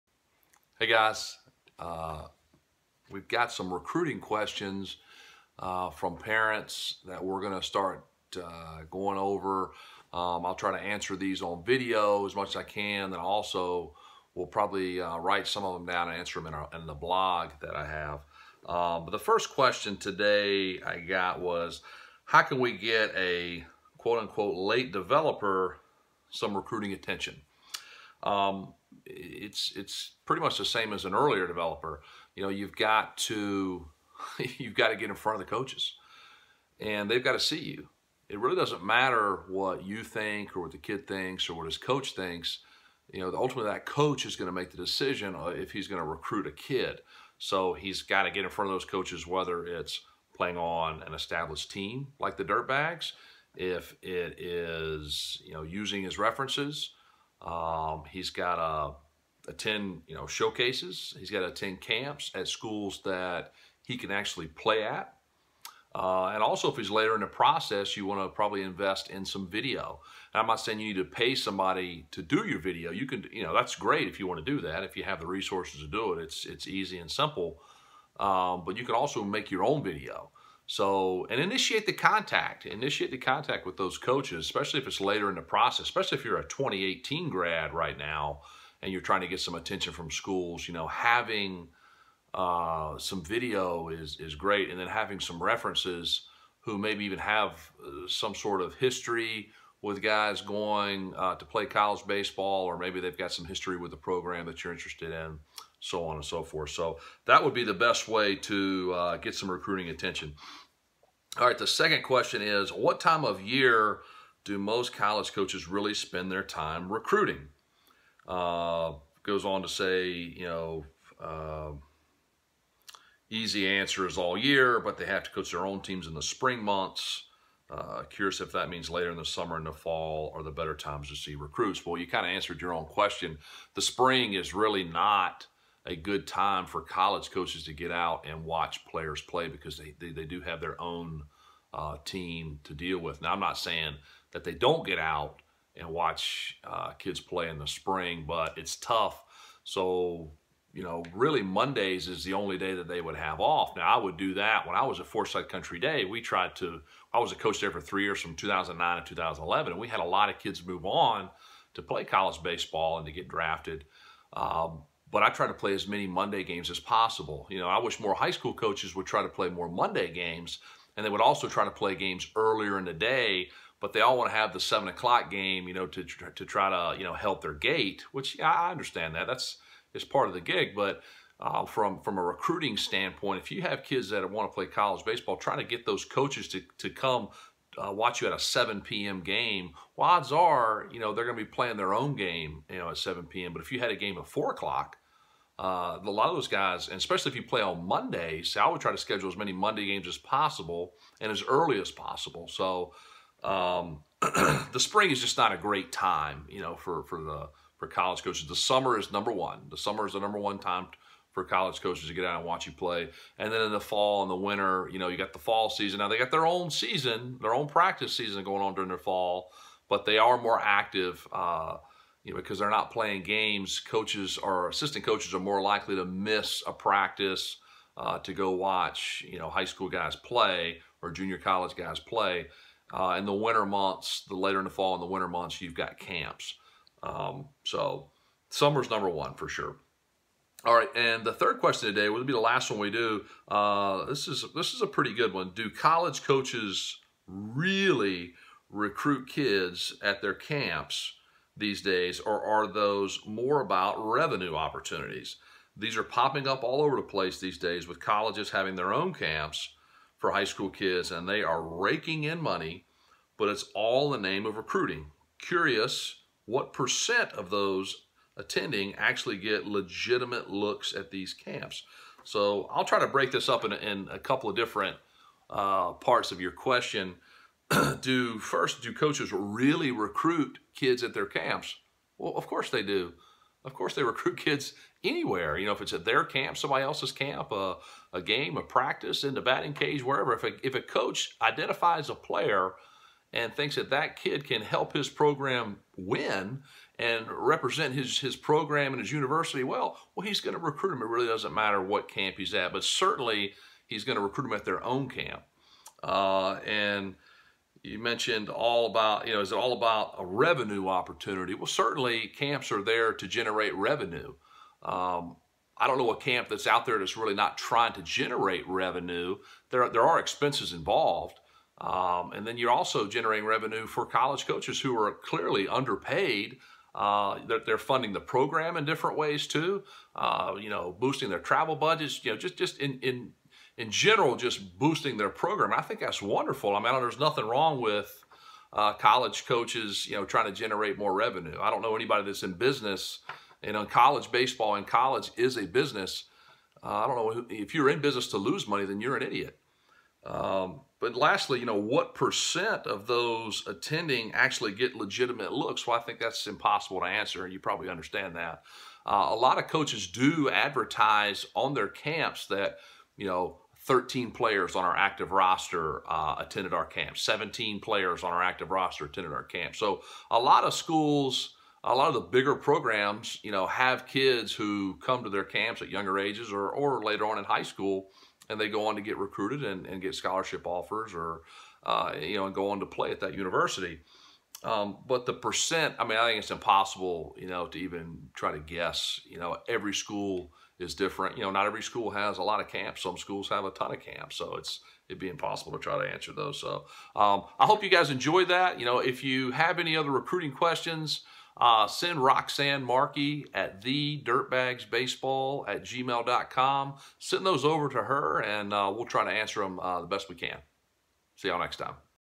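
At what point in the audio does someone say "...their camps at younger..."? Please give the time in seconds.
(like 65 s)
375 s.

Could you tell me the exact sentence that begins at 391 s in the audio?
You know, not every school has a lot of camps.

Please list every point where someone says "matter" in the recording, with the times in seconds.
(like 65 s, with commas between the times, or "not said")
38 s, 301 s.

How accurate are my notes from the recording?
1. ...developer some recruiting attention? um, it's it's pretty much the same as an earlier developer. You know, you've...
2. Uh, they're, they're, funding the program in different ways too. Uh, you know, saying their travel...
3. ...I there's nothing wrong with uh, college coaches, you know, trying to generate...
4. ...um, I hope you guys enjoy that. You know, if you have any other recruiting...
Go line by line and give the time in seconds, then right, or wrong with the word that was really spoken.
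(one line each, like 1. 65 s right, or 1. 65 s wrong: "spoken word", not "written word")
1. 24 s right
2. 326 s wrong: "boosting", not "saying"
3. 336 s right
4. 397 s right.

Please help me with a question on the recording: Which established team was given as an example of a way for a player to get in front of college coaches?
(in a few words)
the Dirtbags.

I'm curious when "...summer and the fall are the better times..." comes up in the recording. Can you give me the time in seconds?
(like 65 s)
129 s.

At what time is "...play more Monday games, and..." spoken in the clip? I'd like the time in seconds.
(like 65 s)
169 s.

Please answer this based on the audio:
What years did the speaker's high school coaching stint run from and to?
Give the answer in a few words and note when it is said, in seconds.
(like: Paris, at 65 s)
2009 to 2011, at 158 s.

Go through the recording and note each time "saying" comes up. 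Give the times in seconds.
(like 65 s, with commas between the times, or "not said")
70 s, 143 s.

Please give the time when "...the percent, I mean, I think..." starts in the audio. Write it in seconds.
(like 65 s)
385 s.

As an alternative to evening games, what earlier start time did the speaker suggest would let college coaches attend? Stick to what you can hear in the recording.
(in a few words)
4 o'clock.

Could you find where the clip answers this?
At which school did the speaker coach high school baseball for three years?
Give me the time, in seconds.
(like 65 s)
155 s.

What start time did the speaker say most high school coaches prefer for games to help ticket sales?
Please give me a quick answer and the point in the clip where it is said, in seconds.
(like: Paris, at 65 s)
7 o'clock, at 174 s.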